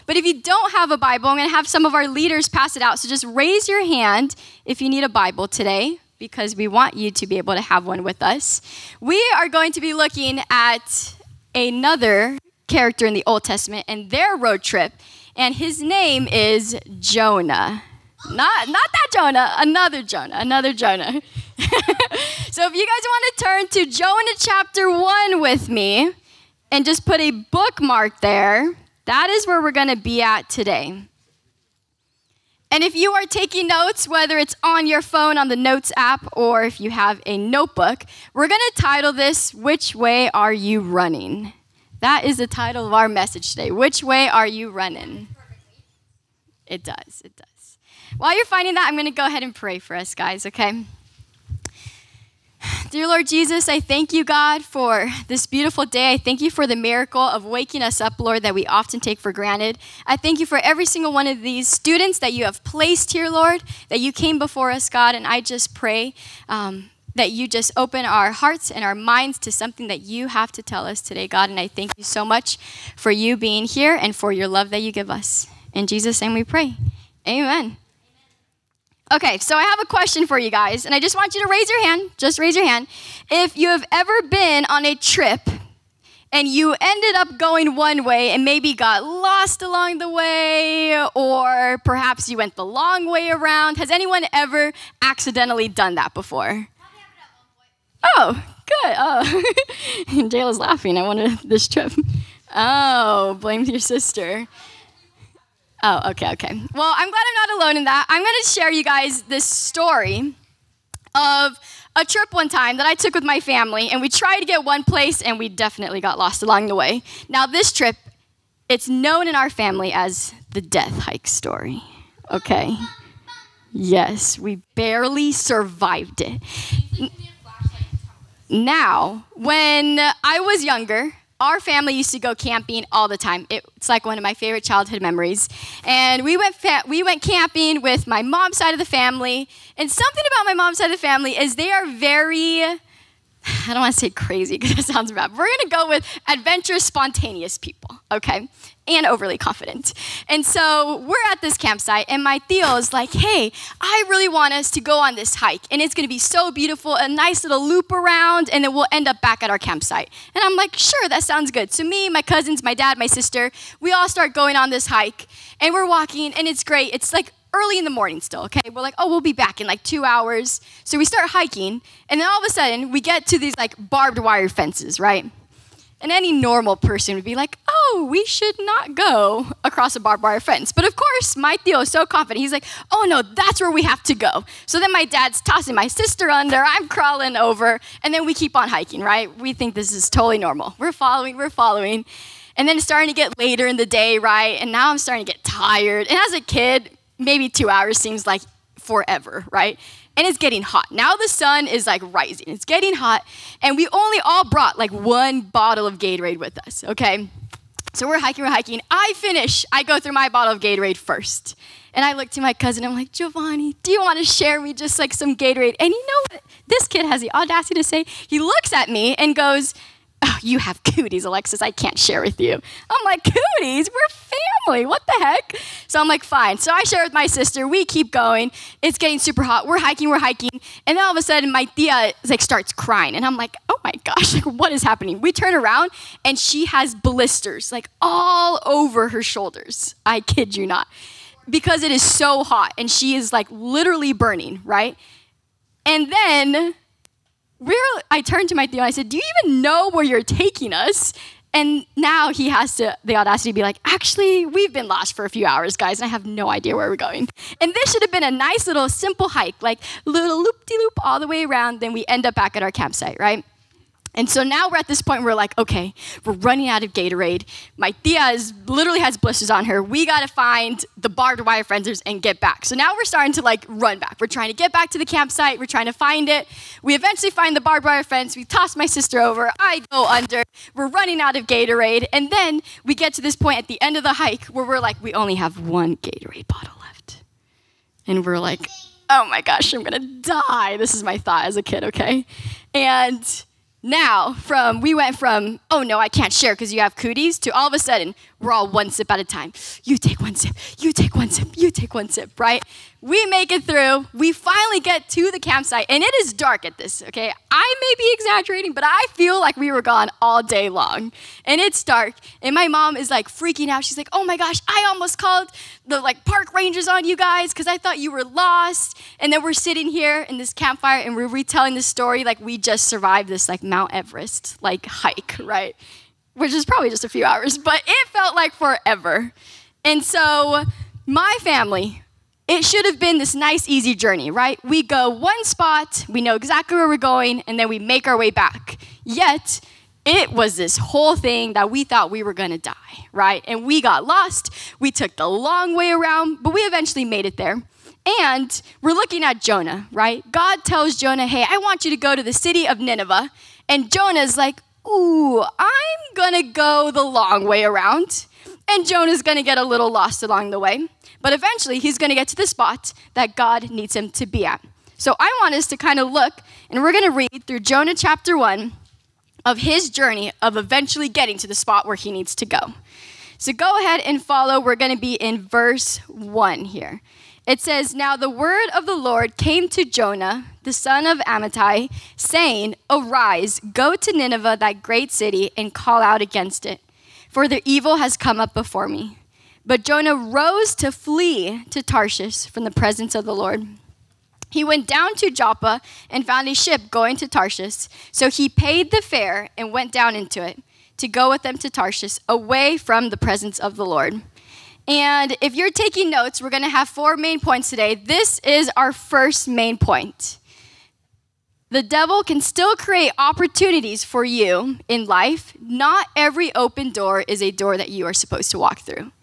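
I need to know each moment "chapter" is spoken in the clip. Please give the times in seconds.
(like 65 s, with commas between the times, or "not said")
24 s, 367 s.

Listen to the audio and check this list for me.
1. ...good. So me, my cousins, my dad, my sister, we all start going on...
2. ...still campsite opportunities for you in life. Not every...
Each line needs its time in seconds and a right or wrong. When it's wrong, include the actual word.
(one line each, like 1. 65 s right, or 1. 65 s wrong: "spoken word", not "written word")
1. 161 s right
2. 412 s wrong: "create", not "campsite".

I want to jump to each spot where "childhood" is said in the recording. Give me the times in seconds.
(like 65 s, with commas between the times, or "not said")
134 s.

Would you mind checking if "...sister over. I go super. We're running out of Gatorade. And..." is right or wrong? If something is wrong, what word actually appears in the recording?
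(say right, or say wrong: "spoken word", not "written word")
wrong: "under", not "super".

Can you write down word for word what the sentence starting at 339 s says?
Yet, it was this whole thing that we thought we were gonna die, right?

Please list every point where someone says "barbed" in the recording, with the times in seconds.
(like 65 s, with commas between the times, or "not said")
173 s, 179 s, 271 s, 277 s.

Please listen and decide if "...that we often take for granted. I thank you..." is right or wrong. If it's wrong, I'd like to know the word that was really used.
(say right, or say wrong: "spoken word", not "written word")
right.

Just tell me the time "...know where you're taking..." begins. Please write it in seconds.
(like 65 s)
249 s.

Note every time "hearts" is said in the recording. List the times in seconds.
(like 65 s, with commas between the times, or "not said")
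68 s.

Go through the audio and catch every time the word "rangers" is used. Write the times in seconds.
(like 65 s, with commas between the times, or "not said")
316 s.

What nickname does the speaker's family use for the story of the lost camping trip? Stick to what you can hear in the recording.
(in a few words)
death hike.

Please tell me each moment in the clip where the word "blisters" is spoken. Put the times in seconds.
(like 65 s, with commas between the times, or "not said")
236 s, 269 s.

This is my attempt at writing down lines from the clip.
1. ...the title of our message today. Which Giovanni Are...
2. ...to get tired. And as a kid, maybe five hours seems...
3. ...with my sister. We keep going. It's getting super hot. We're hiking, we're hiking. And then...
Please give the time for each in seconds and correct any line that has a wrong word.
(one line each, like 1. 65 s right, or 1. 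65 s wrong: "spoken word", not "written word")
1. 42 s wrong: "Way", not "Giovanni"
2. 195 s wrong: "two", not "five"
3. 227 s right.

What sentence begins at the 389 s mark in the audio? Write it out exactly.
But Jonah rose to flee to Tarshish from the presence of the Lord.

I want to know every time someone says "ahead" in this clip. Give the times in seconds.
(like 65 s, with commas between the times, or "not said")
49 s, 373 s.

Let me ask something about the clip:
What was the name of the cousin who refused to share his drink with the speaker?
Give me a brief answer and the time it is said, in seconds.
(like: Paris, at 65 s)
Giovanni, at 213 s.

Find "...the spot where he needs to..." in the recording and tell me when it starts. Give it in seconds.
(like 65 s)
371 s.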